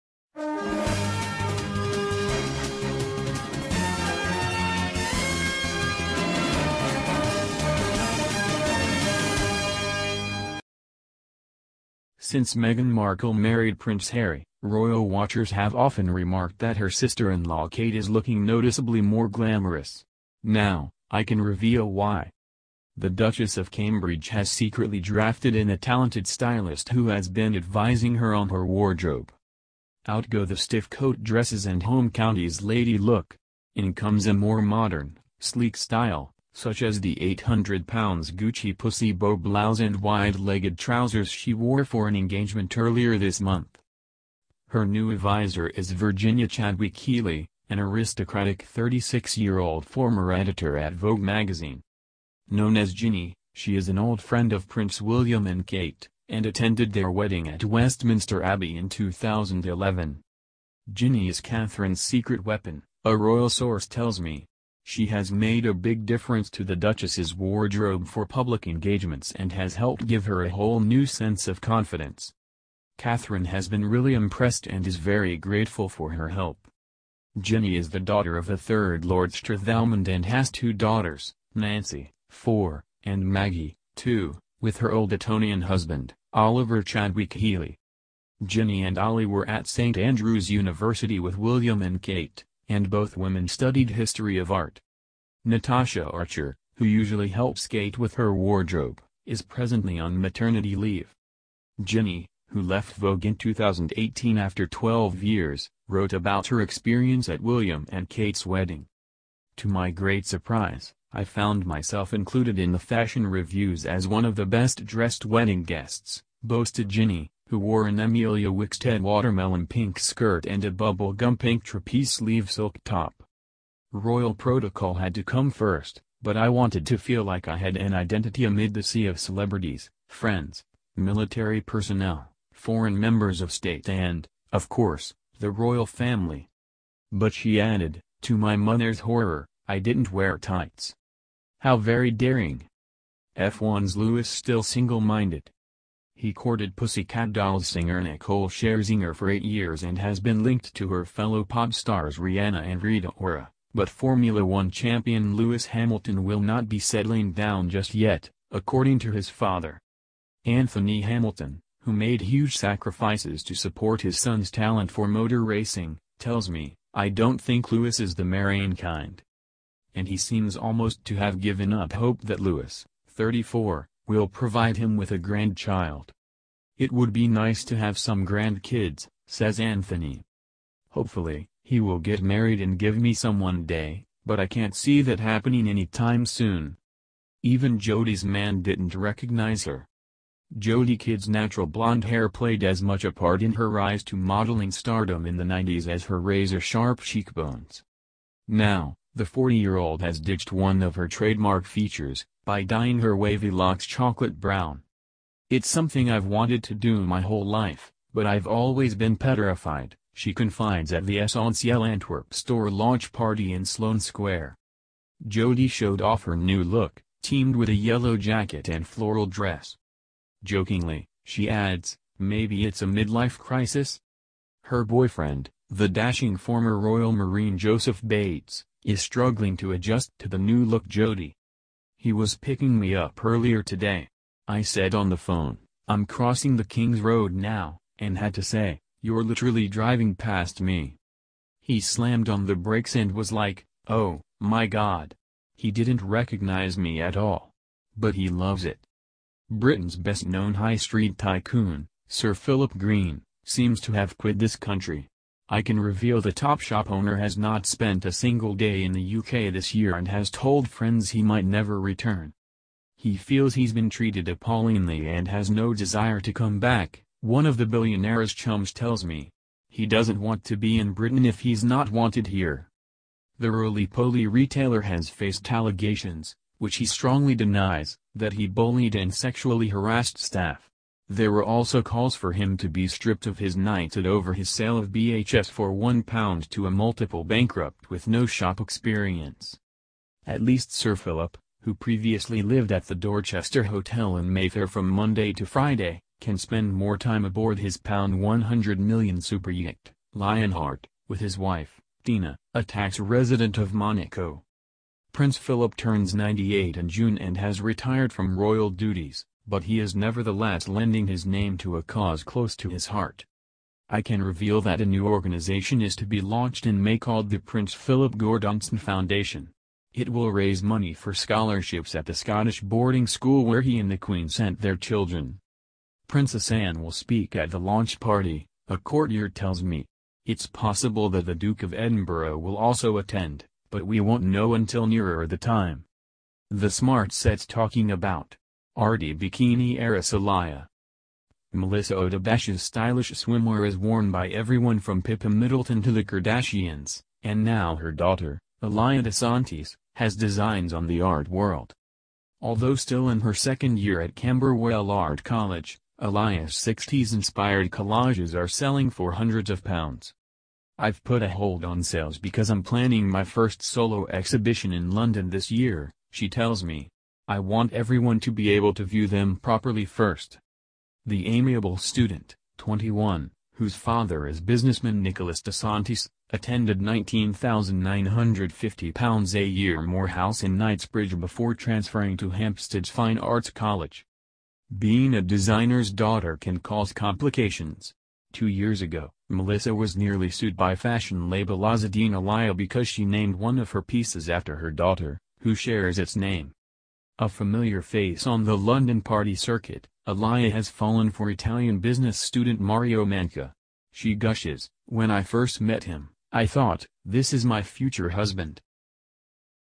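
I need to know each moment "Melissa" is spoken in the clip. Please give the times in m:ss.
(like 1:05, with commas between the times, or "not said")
5:41, 6:29.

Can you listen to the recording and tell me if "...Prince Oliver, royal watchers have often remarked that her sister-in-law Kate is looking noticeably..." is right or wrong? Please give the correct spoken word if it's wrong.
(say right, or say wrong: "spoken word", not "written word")
wrong: "Harry", not "Oliver".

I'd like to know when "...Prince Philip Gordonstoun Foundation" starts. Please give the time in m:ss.
5:17.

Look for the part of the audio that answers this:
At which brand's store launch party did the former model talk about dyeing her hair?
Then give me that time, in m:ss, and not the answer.
3:31.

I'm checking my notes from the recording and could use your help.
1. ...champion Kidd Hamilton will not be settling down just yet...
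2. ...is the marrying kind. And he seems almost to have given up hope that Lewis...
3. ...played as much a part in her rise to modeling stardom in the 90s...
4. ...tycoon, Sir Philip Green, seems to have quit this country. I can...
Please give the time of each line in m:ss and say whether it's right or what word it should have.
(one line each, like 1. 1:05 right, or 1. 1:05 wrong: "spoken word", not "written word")
1. 2:34 wrong: "Lewis", not "Kidd"
2. 2:47 right
3. 3:12 right
4. 4:11 right.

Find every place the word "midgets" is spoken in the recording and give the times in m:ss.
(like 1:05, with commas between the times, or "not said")
not said.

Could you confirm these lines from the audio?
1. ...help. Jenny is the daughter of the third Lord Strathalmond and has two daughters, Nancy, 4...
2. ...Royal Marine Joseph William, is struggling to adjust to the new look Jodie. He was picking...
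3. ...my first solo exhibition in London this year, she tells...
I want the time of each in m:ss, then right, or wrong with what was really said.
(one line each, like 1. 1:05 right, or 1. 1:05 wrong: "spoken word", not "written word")
1. 1:16 right
2. 3:46 wrong: "Bates", not "William"
3. 6:03 right.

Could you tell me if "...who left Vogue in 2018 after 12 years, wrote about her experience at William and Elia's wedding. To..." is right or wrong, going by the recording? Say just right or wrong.
wrong.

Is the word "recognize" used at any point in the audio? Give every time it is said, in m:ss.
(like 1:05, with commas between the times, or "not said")
3:08, 4:06.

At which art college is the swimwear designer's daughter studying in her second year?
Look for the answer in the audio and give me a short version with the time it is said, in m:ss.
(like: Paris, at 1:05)
Camberwell, at 5:54.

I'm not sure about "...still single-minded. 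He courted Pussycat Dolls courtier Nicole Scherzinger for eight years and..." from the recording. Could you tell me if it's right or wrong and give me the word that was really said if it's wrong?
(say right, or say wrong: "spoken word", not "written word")
wrong: "singer", not "courtier".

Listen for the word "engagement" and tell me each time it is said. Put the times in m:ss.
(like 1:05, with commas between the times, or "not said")
0:42, 1:08.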